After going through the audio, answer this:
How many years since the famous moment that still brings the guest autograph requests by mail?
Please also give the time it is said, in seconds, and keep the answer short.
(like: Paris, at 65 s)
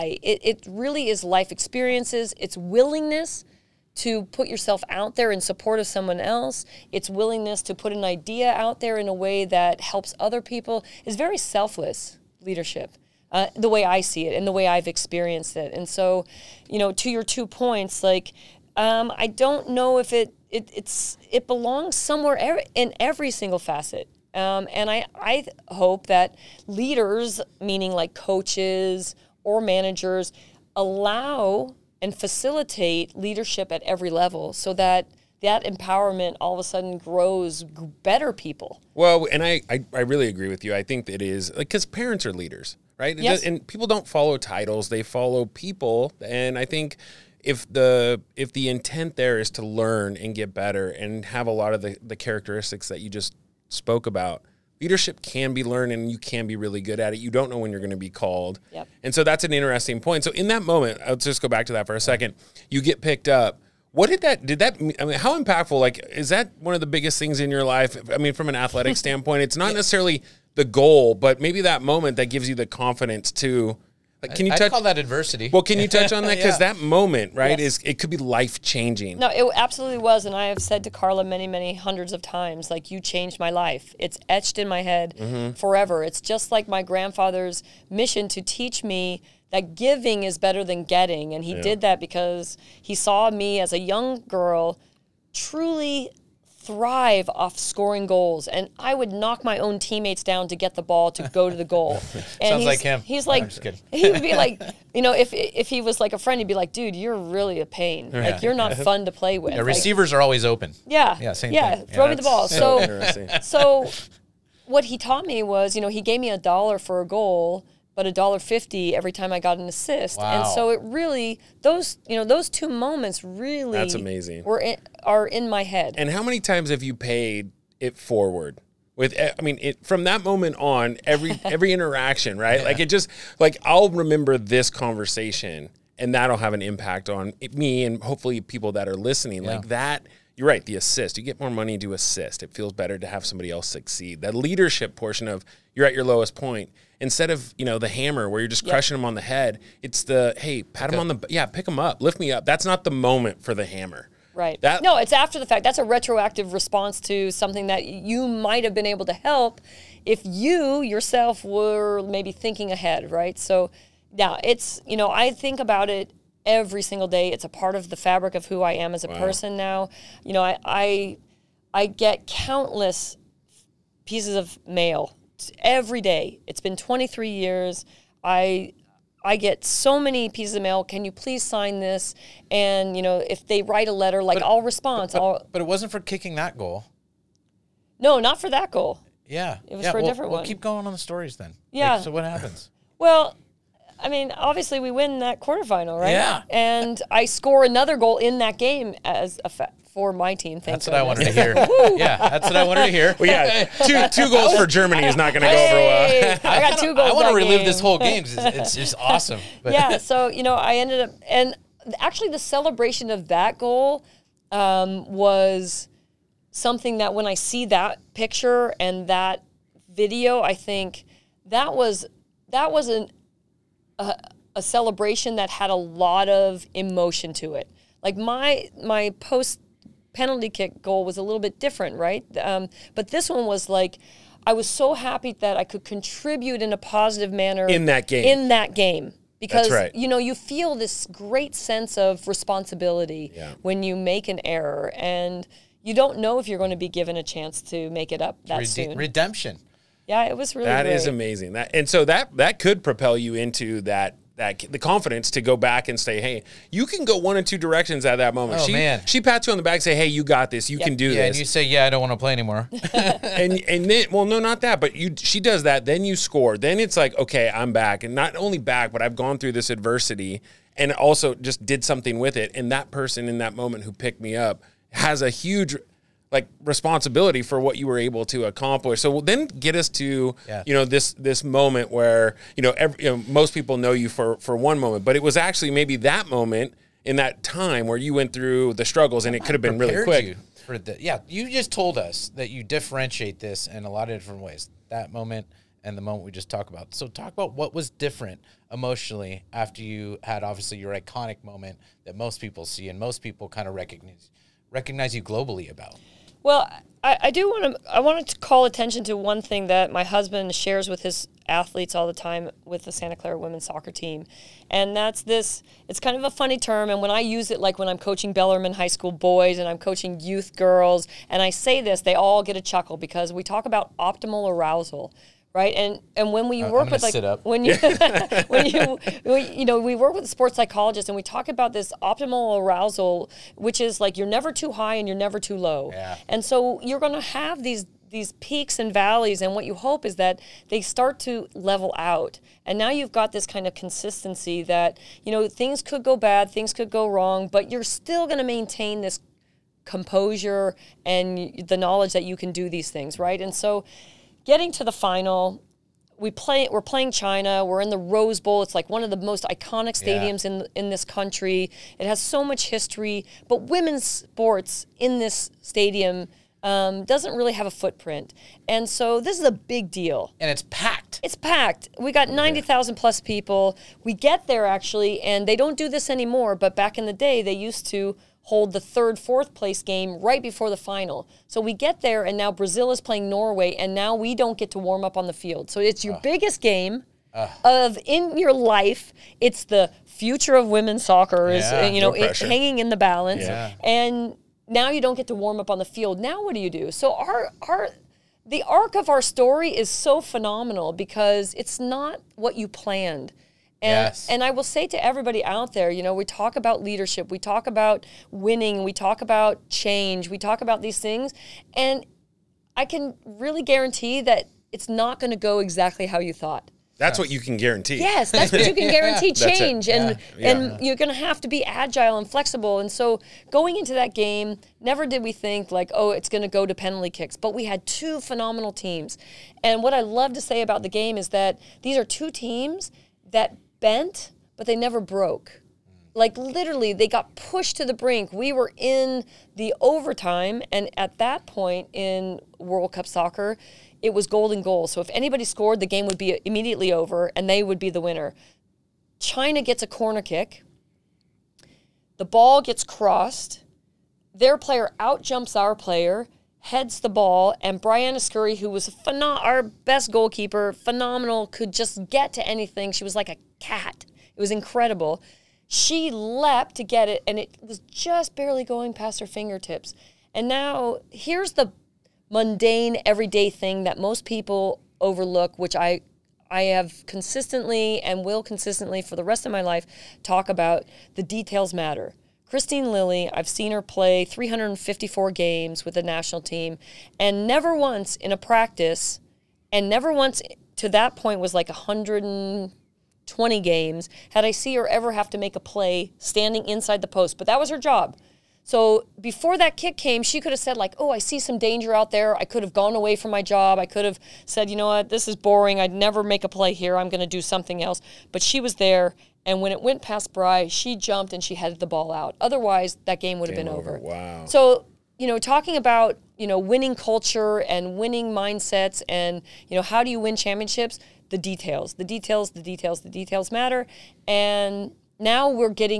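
23, at 176 s.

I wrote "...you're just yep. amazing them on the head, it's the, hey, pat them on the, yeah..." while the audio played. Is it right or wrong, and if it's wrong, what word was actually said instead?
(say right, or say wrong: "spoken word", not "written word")
wrong: "crushing", not "amazing".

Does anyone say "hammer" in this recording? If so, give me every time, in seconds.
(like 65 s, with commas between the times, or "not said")
147 s, 153 s.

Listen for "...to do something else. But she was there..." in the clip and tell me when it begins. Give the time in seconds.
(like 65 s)
507 s.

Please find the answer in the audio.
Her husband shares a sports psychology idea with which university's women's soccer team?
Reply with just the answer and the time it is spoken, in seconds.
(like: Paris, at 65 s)
Santa Clara, at 312 s.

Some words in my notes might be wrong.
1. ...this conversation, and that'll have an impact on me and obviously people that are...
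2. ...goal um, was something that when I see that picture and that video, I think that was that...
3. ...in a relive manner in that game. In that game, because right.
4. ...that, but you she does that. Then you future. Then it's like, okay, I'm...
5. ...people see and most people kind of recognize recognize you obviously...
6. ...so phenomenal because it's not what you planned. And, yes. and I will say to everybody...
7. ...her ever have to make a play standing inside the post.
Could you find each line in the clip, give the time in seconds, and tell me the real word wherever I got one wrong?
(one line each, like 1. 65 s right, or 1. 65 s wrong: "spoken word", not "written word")
1. 134 s wrong: "hopefully", not "obviously"
2. 213 s right
3. 236 s wrong: "positive", not "relive"
4. 264 s wrong: "score", not "future"
5. 302 s wrong: "globally", not "obviously"
6. 399 s right
7. 494 s right.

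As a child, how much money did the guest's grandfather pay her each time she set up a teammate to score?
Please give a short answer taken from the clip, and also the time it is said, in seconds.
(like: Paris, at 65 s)
a dollar fifty, at 118 s.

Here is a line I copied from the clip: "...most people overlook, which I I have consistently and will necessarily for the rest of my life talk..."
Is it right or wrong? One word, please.
wrong.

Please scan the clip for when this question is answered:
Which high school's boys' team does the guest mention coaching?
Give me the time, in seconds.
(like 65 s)
318 s.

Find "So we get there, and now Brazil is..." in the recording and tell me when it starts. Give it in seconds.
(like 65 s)
381 s.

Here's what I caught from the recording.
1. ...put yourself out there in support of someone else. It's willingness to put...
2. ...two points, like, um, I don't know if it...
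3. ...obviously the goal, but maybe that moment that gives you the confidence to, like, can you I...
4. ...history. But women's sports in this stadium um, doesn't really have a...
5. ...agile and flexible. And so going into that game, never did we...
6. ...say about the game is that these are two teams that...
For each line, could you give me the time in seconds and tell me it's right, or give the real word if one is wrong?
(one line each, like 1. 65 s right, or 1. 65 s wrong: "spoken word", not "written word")
1. 4 s right
2. 17 s right
3. 69 s wrong: "necessarily", not "obviously"
4. 362 s right
5. 421 s right
6. 430 s right.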